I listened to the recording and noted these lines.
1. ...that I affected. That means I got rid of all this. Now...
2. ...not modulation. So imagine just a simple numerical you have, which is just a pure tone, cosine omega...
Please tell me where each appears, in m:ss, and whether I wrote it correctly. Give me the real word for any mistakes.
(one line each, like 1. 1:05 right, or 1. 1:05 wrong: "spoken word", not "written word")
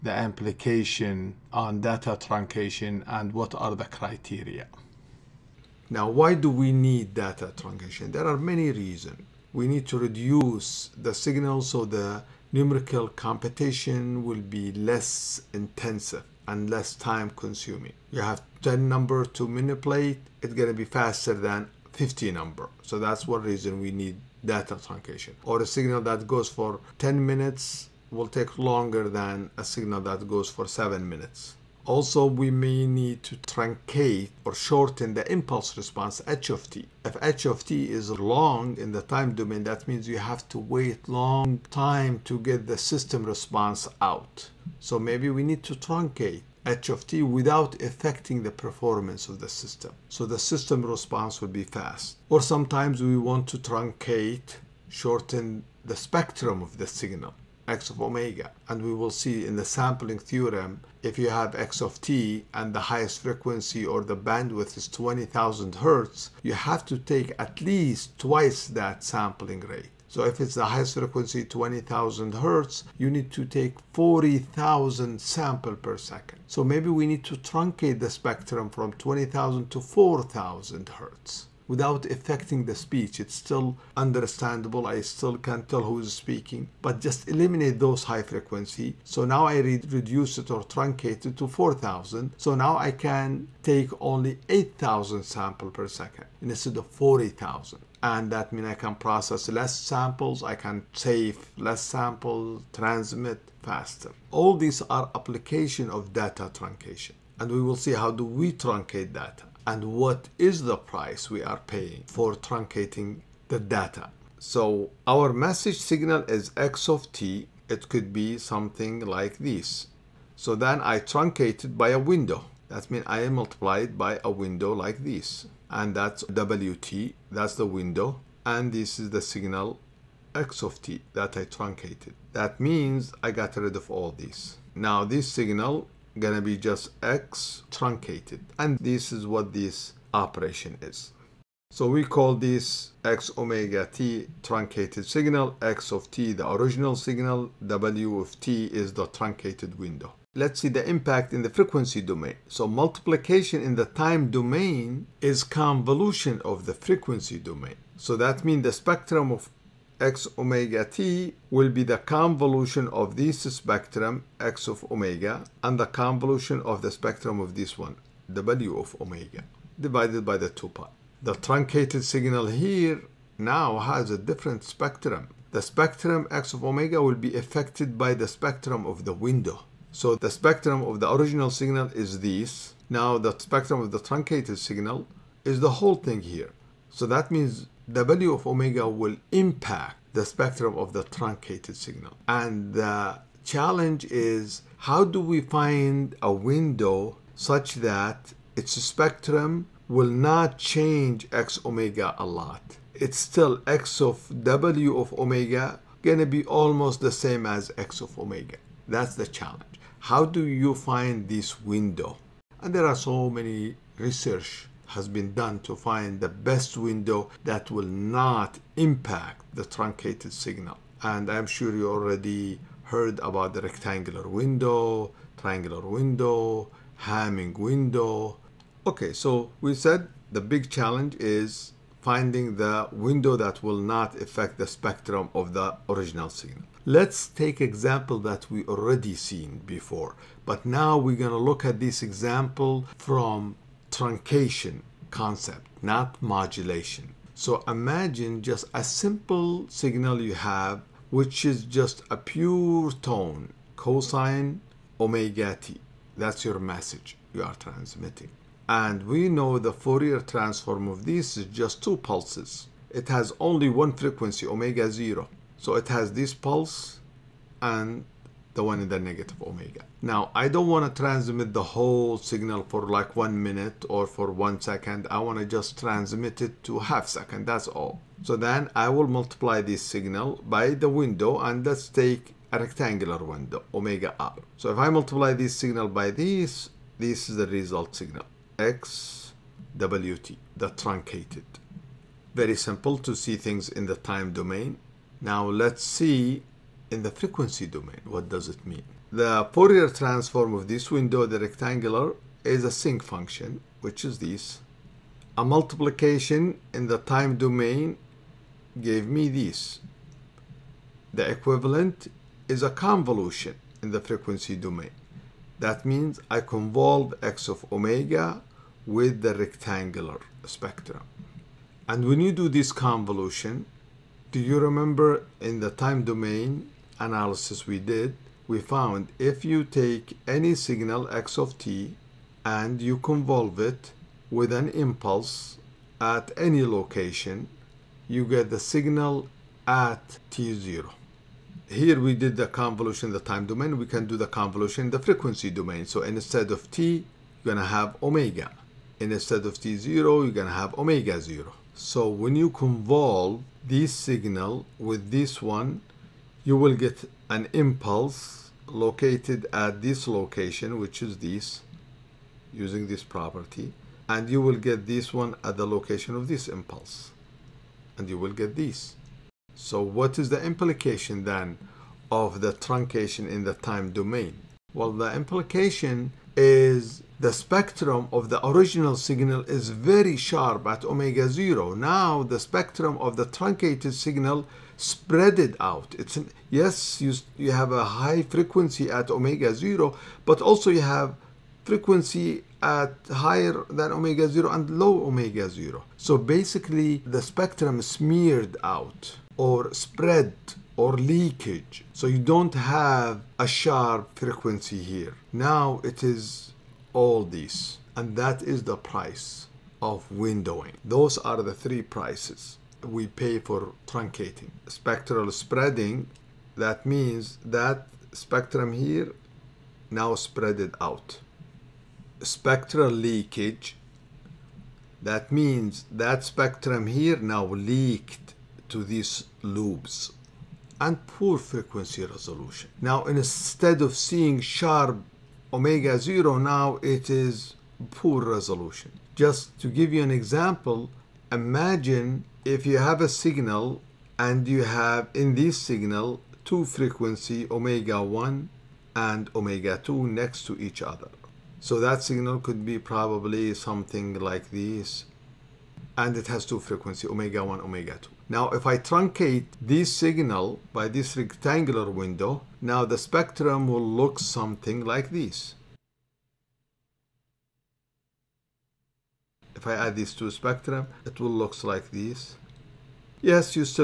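1. 2:11 wrong: "truncated", not "affected"
2. 4:05 wrong: "signal", not "numerical".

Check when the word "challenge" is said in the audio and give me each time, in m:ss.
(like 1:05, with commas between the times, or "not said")
3:13, 3:29, 3:50.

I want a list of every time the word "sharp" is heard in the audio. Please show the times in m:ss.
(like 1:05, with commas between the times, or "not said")
6:20, 6:43, 7:14.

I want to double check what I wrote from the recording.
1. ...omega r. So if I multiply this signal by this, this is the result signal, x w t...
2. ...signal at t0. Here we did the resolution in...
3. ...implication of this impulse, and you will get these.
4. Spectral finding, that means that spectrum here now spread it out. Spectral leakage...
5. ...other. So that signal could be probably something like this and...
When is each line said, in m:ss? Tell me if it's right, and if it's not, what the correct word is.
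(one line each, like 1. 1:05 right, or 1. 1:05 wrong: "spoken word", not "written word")
1. 4:43 right
2. 5:38 wrong: "convolution", not "resolution"
3. 6:05 wrong: "location", not "implication"
4. 6:54 wrong: "spreading", not "finding"
5. 7:30 right.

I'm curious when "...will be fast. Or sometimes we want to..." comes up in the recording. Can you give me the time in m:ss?
0:51.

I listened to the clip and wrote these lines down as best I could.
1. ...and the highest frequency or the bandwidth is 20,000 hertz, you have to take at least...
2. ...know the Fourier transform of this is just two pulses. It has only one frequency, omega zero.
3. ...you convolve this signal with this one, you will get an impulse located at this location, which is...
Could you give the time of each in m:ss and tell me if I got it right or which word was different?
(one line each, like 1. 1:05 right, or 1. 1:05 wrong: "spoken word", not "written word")
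1. 1:02 right
2. 4:19 right
3. 5:52 right.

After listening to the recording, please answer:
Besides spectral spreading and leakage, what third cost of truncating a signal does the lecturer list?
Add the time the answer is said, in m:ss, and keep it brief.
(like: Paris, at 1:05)
poor frequency resolution, at 7:11.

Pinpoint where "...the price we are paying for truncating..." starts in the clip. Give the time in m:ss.
1:50.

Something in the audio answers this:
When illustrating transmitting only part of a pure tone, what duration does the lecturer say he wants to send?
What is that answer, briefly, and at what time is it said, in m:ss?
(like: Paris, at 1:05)
half second, at 4:36.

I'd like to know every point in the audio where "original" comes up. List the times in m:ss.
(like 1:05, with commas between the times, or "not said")
2:26, 3:01, 3:55, 6:18.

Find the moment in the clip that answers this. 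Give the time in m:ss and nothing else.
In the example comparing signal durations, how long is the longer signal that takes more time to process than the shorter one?
0:26.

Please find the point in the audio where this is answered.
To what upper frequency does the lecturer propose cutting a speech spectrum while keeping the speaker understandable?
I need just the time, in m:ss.
1:19.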